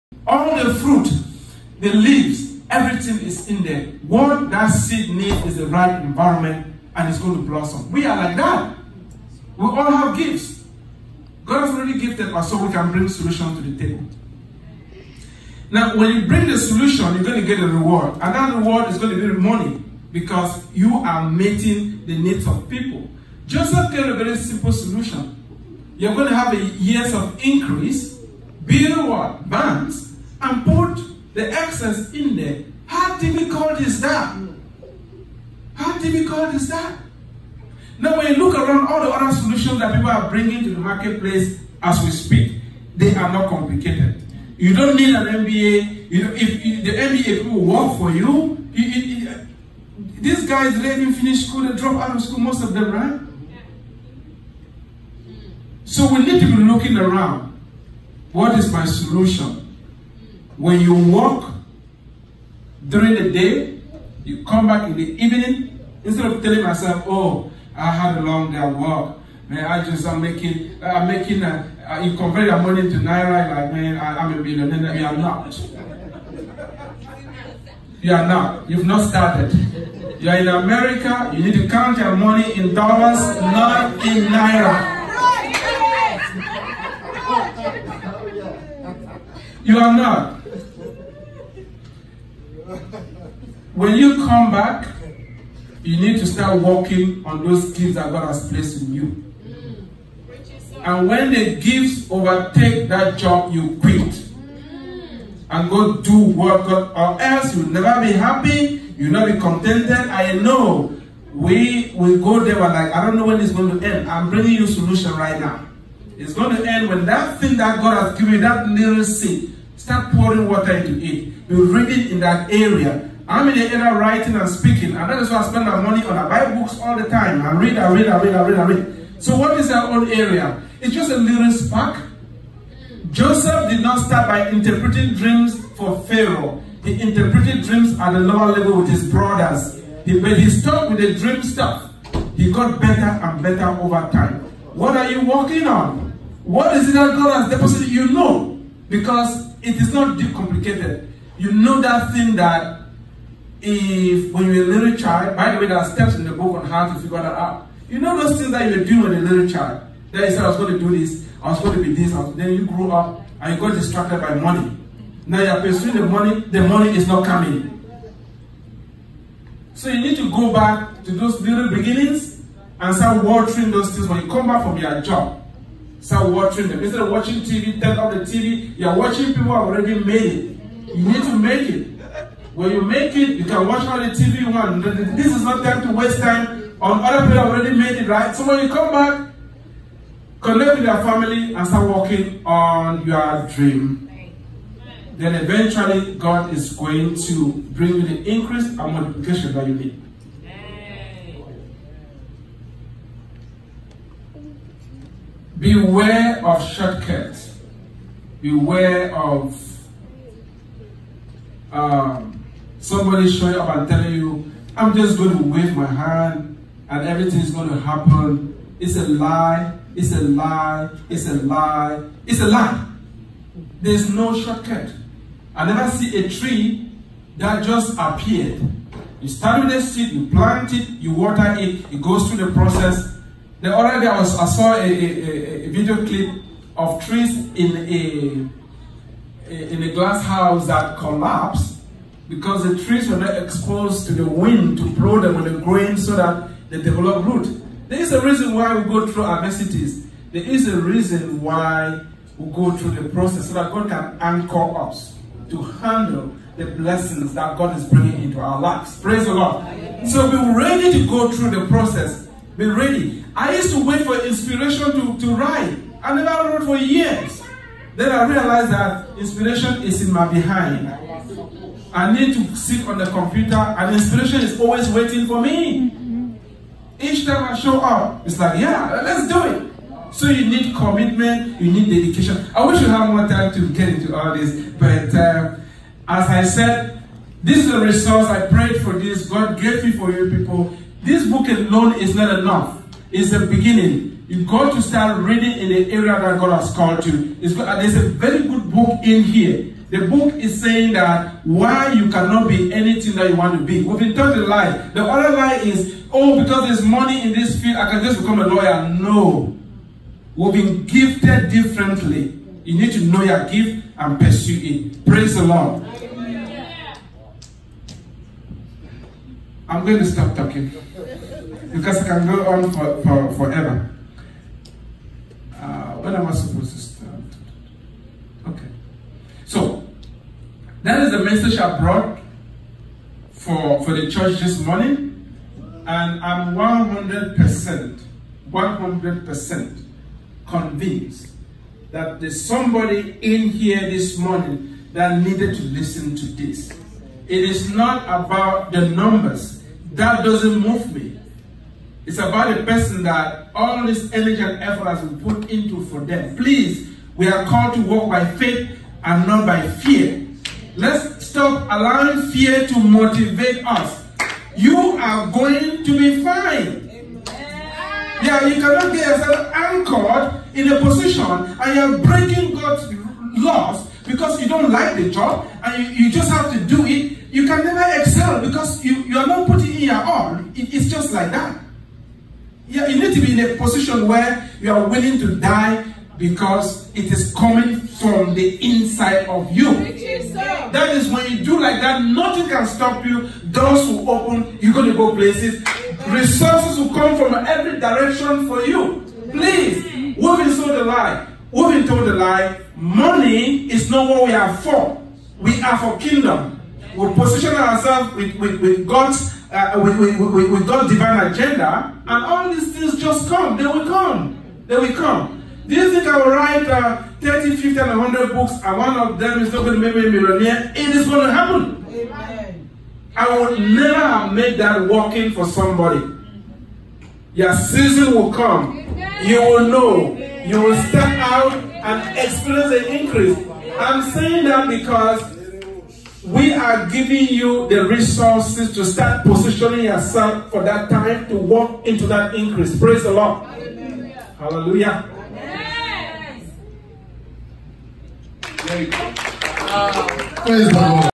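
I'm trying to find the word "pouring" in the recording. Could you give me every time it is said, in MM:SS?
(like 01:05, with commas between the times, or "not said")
02:00.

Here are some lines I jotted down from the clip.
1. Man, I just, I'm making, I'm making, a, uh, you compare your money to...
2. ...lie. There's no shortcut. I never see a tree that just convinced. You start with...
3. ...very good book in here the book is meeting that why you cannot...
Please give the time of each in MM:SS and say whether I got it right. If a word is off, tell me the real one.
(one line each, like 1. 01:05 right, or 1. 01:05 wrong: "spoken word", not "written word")
1. 01:09 right
2. 03:42 wrong: "appeared", not "convinced"
3. 04:58 wrong: "saying", not "meeting".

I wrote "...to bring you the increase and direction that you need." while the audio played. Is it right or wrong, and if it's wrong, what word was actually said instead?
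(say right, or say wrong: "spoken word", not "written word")
wrong: "multiplication", not "direction".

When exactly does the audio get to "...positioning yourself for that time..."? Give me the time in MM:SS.
07:19.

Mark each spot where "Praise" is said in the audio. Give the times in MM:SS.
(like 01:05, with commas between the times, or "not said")
04:19, 05:15, 07:22.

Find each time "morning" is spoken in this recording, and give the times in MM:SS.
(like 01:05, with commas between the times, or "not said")
05:34, 05:44.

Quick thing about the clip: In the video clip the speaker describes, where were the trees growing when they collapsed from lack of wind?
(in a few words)
A glass house.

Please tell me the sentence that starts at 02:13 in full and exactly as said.
Joseph did not start by interpreting dreams for Pharaoh.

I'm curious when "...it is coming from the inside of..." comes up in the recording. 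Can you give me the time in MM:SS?
06:26.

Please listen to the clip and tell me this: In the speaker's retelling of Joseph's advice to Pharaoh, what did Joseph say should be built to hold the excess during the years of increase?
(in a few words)
Banks.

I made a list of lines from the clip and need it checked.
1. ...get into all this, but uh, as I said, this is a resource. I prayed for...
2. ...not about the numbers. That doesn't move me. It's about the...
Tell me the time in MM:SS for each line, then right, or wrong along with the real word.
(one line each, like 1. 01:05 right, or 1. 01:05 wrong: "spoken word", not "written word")
1. 04:43 right
2. 05:47 right.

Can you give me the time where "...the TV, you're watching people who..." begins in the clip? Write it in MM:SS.
02:58.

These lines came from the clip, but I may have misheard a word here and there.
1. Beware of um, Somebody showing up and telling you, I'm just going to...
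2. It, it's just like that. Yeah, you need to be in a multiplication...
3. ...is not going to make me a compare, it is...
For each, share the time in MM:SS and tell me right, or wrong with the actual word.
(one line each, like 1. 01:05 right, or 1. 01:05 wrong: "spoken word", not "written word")
1. 03:28 right
2. 06:20 wrong: "position", not "multiplication"
3. 06:59 wrong: "millionaire", not "compare".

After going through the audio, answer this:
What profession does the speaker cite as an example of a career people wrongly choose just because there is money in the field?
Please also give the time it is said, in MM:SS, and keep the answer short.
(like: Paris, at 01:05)
Lawyer, at 05:08.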